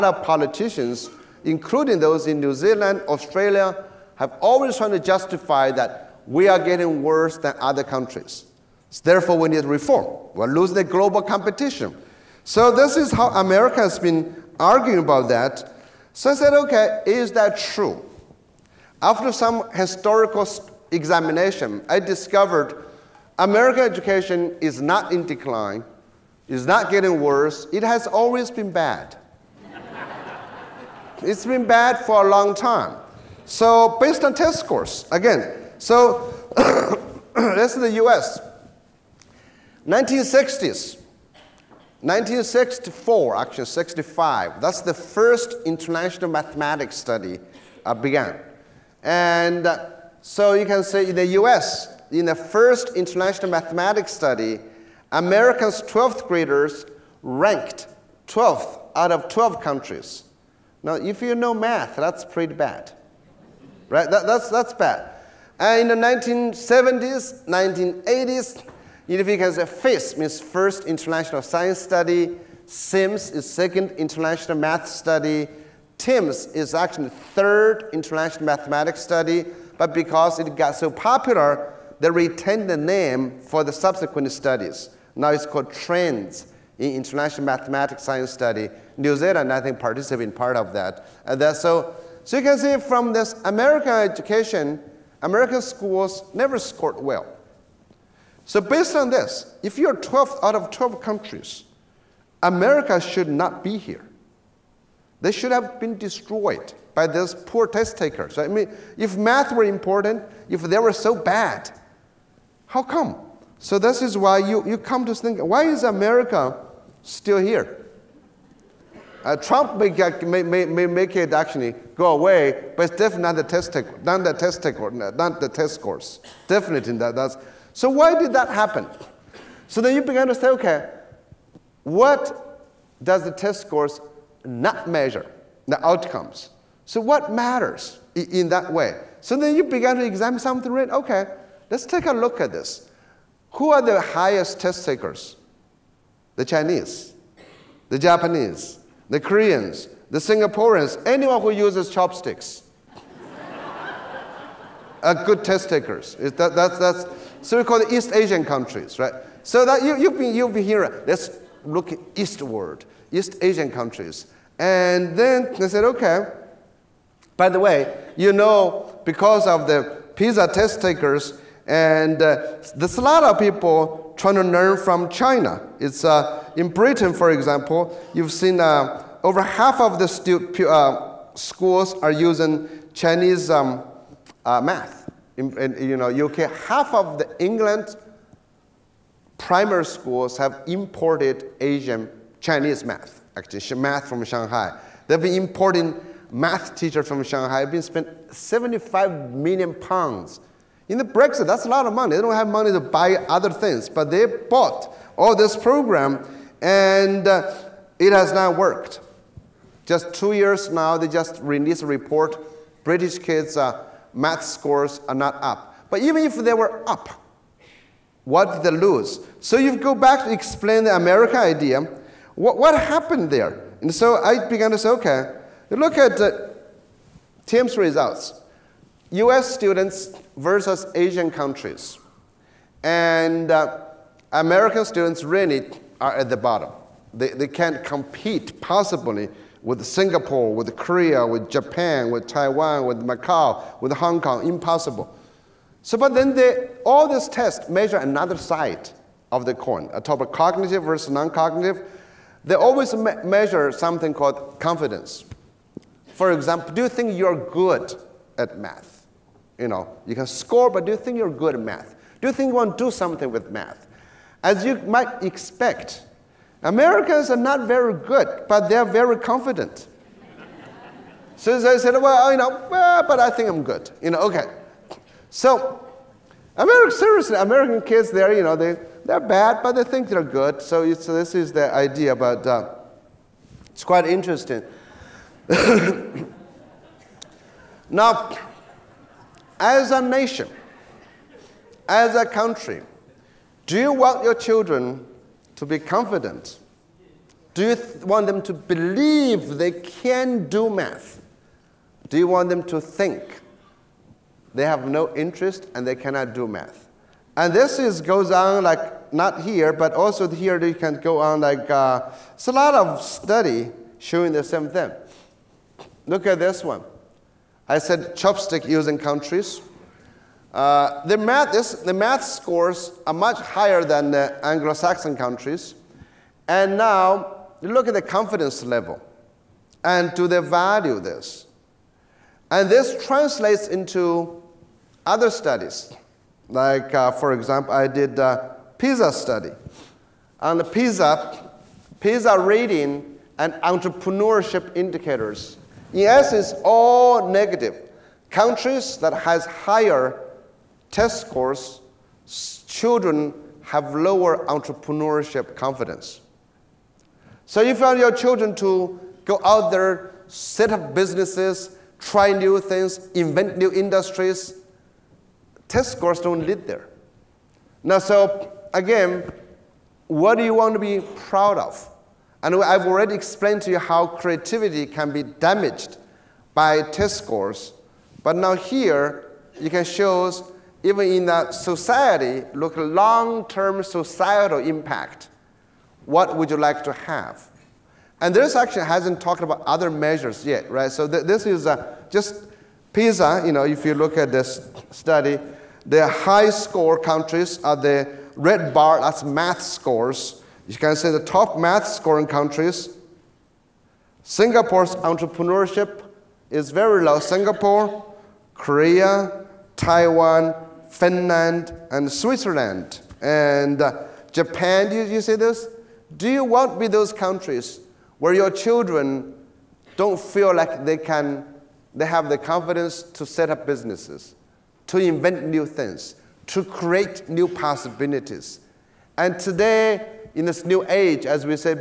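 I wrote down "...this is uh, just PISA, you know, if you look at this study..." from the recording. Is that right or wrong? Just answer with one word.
right.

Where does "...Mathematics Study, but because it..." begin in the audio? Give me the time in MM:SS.
01:18.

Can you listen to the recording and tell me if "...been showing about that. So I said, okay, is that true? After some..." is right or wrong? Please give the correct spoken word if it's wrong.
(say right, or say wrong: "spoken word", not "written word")
wrong: "arguing", not "showing".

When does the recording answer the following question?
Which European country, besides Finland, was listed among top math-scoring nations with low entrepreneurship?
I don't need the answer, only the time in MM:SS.
06:52.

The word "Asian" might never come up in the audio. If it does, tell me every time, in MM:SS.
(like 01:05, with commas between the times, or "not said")
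02:38, 02:43, 03:11, 03:50.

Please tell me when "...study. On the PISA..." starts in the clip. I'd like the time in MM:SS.
05:39.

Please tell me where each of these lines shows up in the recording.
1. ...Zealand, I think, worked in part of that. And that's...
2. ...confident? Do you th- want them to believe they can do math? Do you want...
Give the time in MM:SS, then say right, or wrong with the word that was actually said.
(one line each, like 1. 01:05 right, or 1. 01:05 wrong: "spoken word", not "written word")
1. 01:29 wrong: "participated", not "worked"
2. 04:55 right.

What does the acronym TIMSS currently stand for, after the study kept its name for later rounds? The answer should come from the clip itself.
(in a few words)
Trends in International Mathematics Science Study.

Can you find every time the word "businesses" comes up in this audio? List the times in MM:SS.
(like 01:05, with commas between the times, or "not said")
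06:00, 07:03.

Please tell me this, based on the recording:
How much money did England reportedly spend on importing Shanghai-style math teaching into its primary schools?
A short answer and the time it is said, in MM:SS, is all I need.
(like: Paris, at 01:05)
75 million pounds, at 03:18.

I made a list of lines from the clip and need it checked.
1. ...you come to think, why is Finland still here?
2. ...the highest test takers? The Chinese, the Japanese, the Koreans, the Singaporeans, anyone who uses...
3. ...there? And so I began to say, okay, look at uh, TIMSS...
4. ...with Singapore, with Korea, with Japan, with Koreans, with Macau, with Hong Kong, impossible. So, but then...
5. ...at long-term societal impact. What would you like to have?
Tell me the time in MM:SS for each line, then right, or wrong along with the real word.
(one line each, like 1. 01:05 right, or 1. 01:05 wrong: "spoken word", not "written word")
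1. 01:54 wrong: "America", not "Finland"
2. 02:23 right
3. 03:43 right
4. 03:59 wrong: "Taiwan", not "Koreans"
5. 06:22 right.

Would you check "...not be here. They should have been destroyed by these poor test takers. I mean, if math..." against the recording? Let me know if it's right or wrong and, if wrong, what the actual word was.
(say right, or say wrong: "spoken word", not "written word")
right.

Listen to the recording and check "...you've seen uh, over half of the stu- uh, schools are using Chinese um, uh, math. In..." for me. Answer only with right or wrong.
right.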